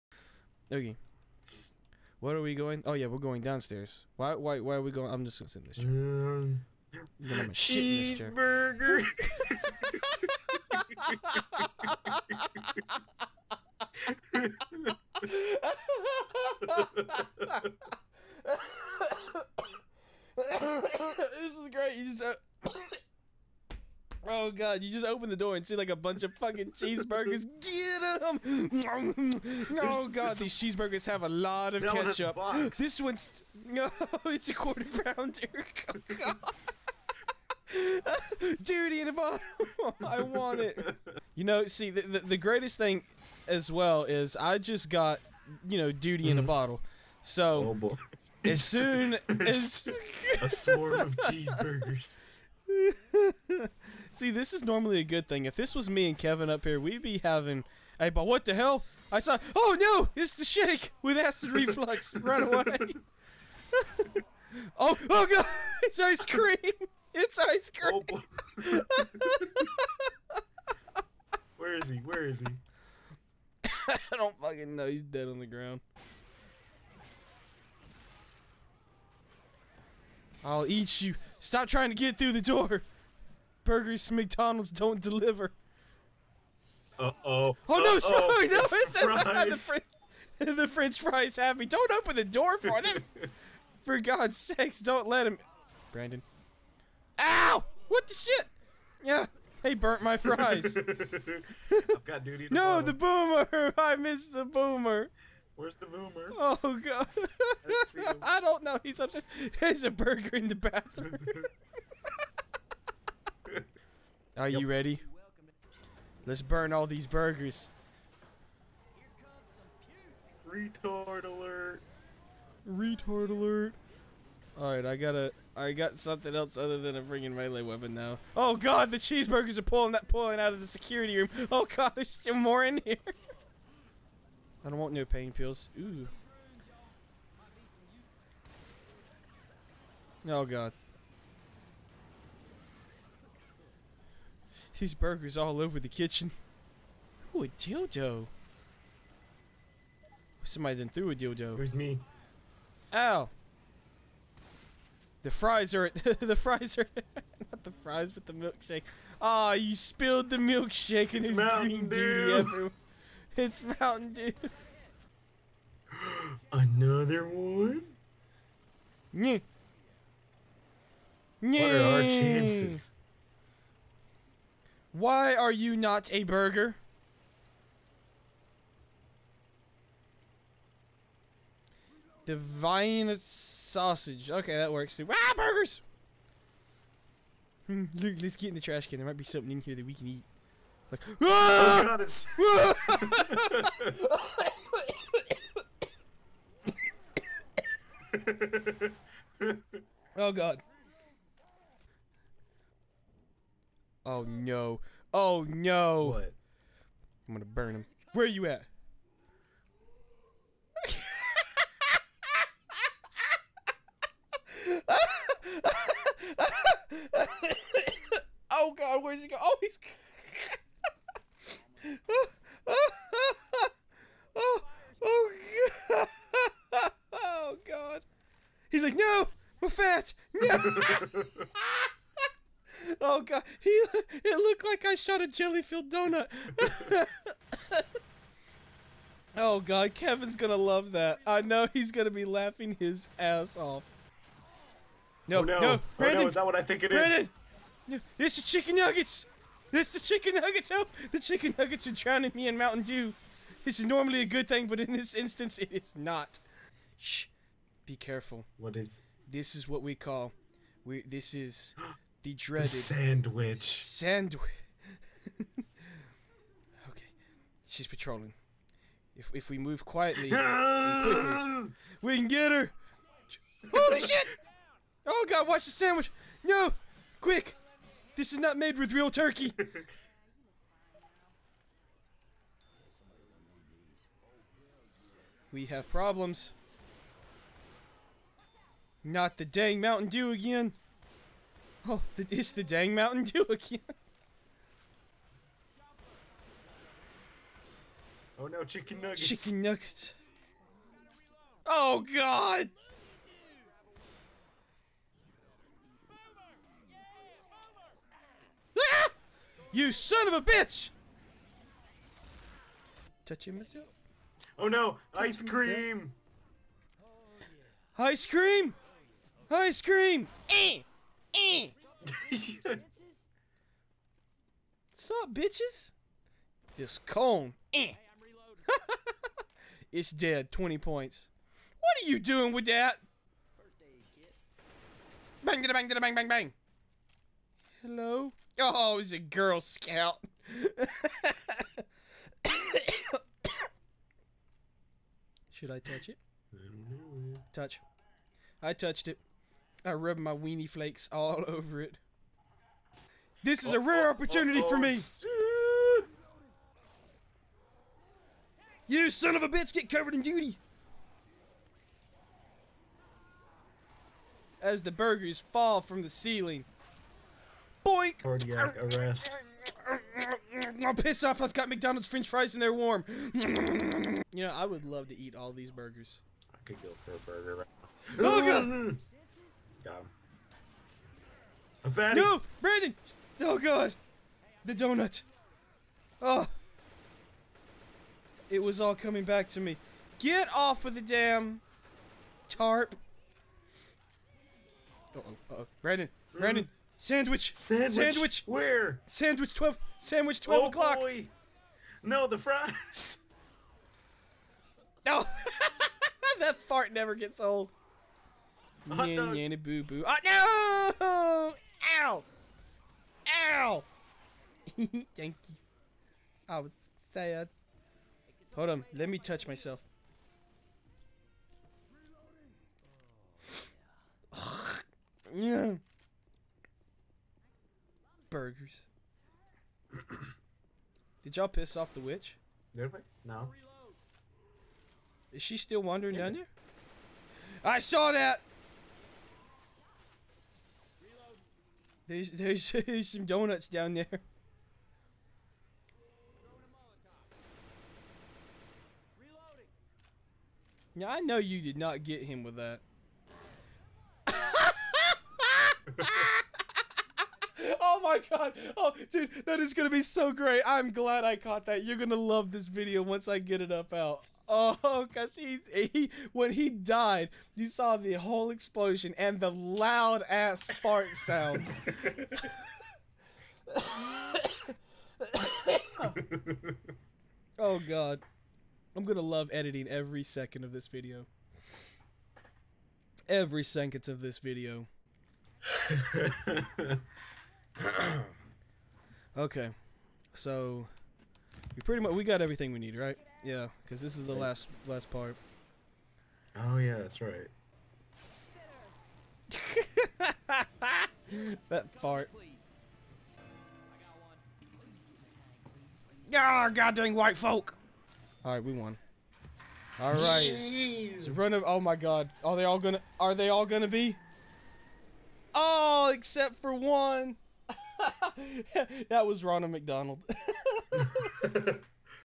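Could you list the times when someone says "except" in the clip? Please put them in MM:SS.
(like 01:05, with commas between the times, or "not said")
08:36.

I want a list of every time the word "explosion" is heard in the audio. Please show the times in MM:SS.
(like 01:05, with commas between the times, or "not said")
07:48.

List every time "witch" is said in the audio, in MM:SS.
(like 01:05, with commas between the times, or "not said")
07:11.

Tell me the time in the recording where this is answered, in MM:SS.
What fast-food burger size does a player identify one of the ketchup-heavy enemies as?
00:34.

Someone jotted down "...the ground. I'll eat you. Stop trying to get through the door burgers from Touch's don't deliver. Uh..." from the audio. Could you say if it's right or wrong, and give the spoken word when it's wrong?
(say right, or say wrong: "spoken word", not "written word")
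wrong: "McDonald", not "Touch".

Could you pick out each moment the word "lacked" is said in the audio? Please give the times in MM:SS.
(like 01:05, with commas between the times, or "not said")
not said.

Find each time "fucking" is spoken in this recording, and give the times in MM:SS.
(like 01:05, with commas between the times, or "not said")
00:26, 01:14.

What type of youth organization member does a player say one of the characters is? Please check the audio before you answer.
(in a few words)
Girl Scout.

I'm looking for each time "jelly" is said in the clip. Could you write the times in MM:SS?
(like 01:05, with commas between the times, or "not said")
03:55.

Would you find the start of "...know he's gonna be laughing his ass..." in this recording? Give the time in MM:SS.
04:01.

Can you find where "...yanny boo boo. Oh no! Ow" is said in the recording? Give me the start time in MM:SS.
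06:49.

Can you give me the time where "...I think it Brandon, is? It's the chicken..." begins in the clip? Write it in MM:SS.
04:06.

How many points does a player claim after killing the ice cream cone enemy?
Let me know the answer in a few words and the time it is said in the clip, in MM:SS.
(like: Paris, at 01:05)
20, at 05:30.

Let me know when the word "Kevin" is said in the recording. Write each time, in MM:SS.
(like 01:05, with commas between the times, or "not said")
00:56, 03:59.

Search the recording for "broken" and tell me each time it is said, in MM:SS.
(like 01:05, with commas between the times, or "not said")
not said.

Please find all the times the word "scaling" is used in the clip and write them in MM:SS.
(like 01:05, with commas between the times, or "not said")
not said.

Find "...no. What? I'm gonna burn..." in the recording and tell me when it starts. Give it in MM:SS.
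03:25.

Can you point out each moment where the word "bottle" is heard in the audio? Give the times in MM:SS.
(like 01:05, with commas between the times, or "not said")
00:39, 00:46.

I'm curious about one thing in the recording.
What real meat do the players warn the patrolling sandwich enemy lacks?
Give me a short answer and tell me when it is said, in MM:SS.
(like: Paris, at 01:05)
Turkey, at 04:38.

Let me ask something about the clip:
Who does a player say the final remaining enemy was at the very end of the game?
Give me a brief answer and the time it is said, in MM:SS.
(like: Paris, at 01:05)
Ronald McDonald, at 08:39.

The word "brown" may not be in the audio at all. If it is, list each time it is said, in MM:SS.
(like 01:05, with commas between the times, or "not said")
not said.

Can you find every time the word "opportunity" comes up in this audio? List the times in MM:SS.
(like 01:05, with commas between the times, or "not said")
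05:54.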